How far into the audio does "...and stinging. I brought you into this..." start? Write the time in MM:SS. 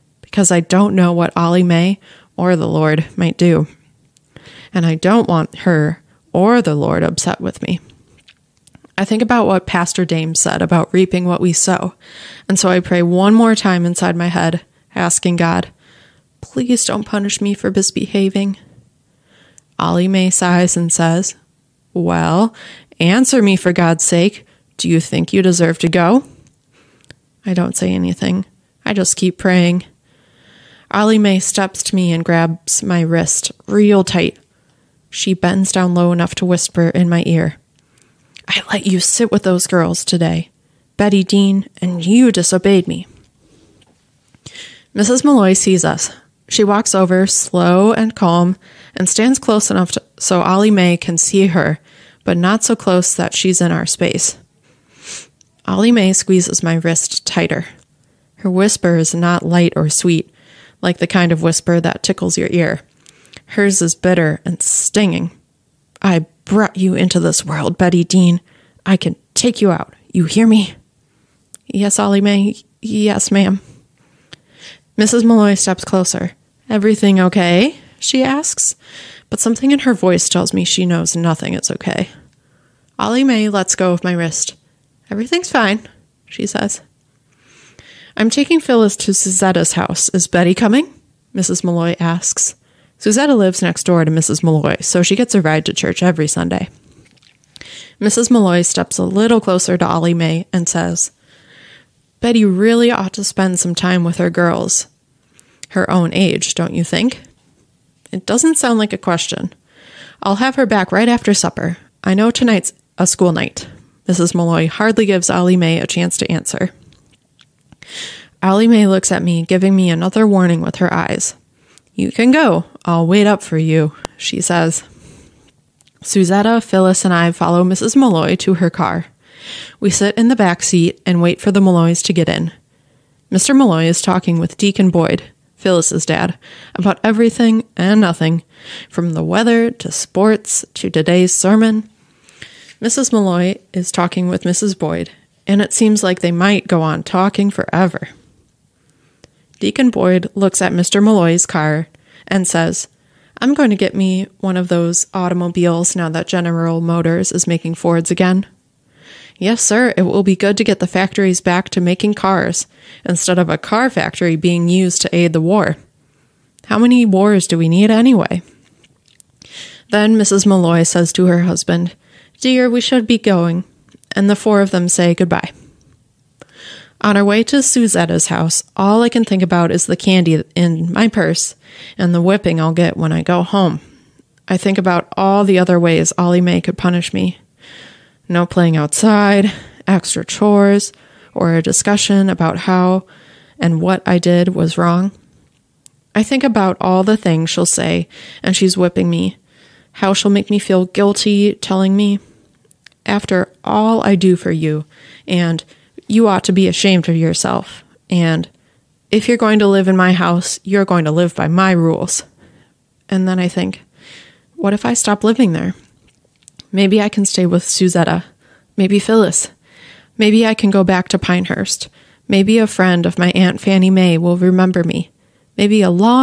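01:04.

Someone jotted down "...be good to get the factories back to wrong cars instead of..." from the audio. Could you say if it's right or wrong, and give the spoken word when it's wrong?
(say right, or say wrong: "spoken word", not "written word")
wrong: "making", not "wrong".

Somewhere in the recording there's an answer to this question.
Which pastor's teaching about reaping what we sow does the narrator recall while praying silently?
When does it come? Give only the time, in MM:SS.
00:09.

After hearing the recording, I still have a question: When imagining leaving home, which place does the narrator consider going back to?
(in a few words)
Pinehurst.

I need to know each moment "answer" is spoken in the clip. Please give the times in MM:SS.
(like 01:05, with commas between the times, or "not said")
00:22, 01:56.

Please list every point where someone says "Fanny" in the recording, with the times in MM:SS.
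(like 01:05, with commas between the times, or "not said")
03:43.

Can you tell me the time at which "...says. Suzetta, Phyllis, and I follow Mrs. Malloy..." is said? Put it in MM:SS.
02:04.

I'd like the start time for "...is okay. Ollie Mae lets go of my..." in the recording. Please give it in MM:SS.
01:21.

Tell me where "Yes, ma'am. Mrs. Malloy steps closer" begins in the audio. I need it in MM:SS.
01:12.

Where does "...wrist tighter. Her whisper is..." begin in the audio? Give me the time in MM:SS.
00:56.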